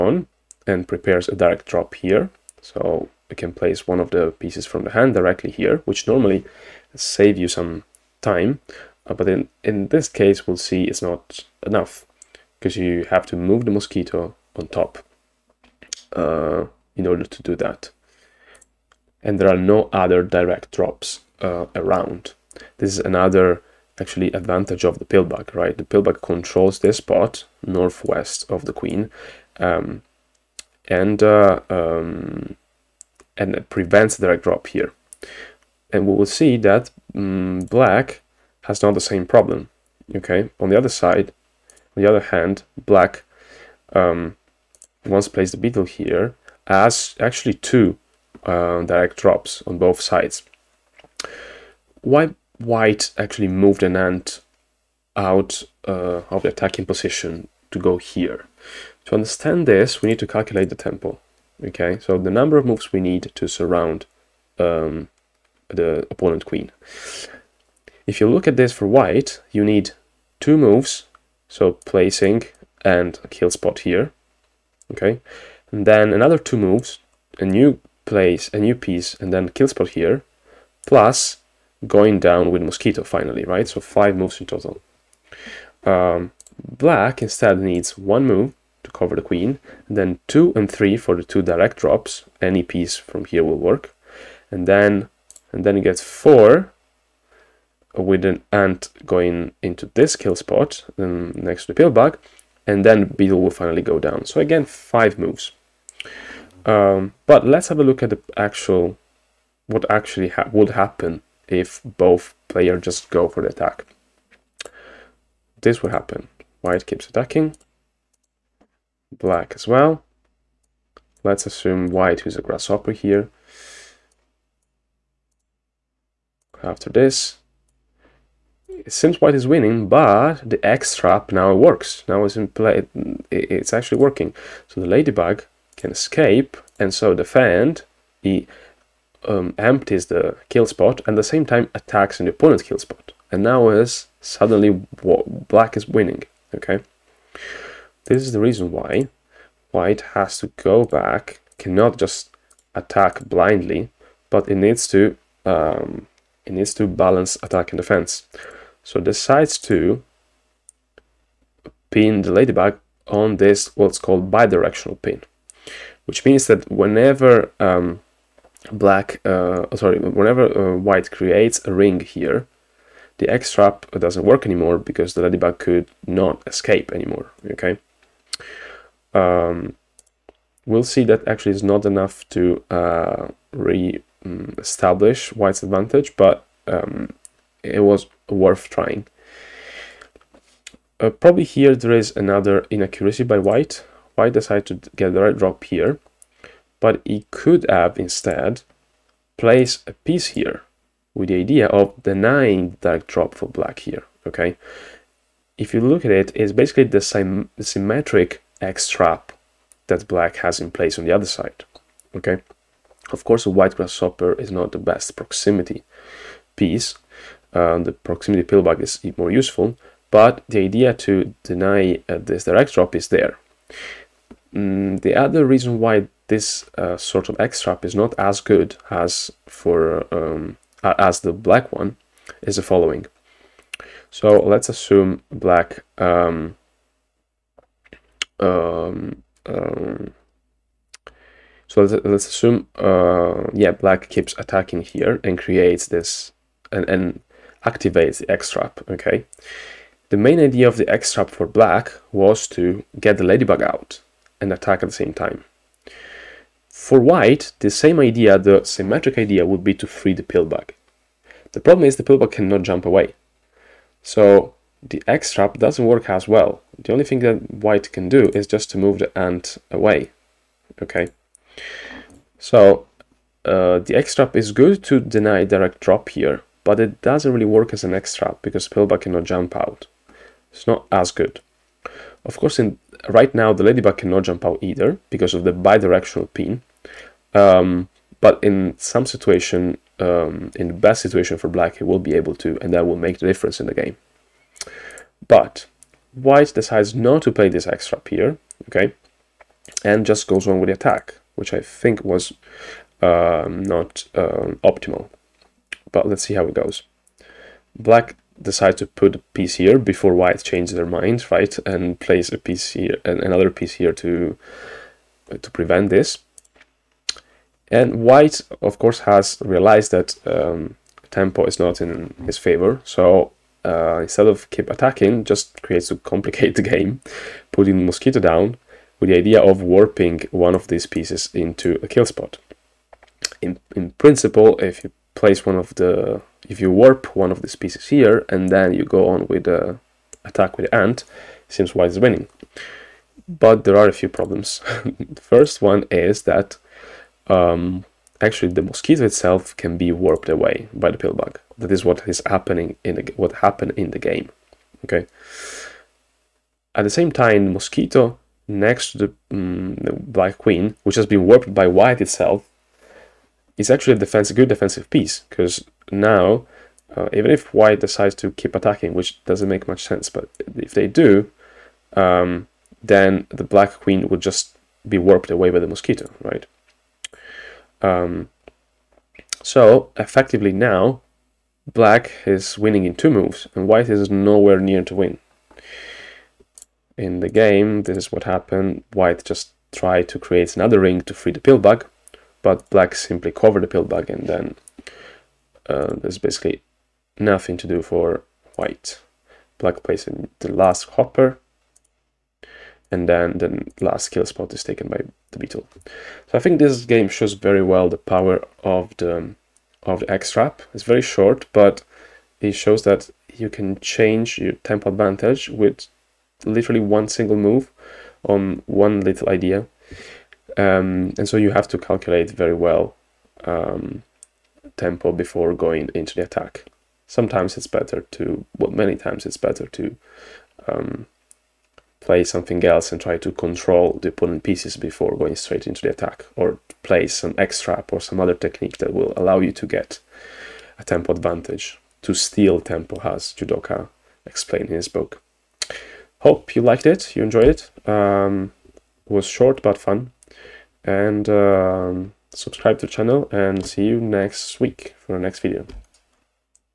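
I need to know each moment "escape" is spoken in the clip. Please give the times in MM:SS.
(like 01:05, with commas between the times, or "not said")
02:15, 02:56.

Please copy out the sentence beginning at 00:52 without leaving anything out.
Why white actually moved an ant out uh, of the attacking position to go here.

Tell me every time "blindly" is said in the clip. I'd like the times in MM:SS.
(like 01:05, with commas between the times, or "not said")
02:33.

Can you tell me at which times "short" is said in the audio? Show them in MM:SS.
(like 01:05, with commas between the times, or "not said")
06:51, 07:29.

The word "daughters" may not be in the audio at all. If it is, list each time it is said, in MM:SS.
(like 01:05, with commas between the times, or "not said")
not said.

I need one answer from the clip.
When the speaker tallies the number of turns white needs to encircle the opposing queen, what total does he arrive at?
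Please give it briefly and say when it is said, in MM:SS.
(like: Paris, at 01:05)
5, at 01:23.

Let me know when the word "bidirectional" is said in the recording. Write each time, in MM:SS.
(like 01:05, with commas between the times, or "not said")
02:44, 04:45.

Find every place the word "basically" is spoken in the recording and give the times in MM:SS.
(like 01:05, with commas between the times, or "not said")
03:26, 06:36.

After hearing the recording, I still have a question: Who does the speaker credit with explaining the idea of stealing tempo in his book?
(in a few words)
Judoka.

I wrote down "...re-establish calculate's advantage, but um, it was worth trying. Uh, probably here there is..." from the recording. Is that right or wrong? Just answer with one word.
wrong.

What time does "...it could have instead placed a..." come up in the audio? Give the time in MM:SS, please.
03:17.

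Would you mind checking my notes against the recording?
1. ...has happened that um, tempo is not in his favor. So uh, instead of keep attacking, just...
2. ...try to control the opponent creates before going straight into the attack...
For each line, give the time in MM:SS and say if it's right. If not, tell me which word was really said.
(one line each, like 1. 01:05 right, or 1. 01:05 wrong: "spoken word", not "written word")
1. 05:18 wrong: "realized", not "happened"
2. 07:12 wrong: "pieces", not "creates".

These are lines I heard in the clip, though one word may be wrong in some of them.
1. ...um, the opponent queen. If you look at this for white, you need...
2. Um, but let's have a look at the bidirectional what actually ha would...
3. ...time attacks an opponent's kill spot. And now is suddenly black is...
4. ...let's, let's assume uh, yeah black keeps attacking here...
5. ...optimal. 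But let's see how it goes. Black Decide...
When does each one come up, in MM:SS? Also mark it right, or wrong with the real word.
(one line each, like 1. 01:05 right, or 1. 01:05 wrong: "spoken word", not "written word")
1. 01:04 right
2. 01:46 wrong: "actual", not "bidirectional"
3. 02:21 right
4. 04:01 right
5. 05:04 right.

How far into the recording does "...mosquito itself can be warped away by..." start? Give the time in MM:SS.
05:48.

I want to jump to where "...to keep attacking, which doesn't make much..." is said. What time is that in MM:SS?
06:08.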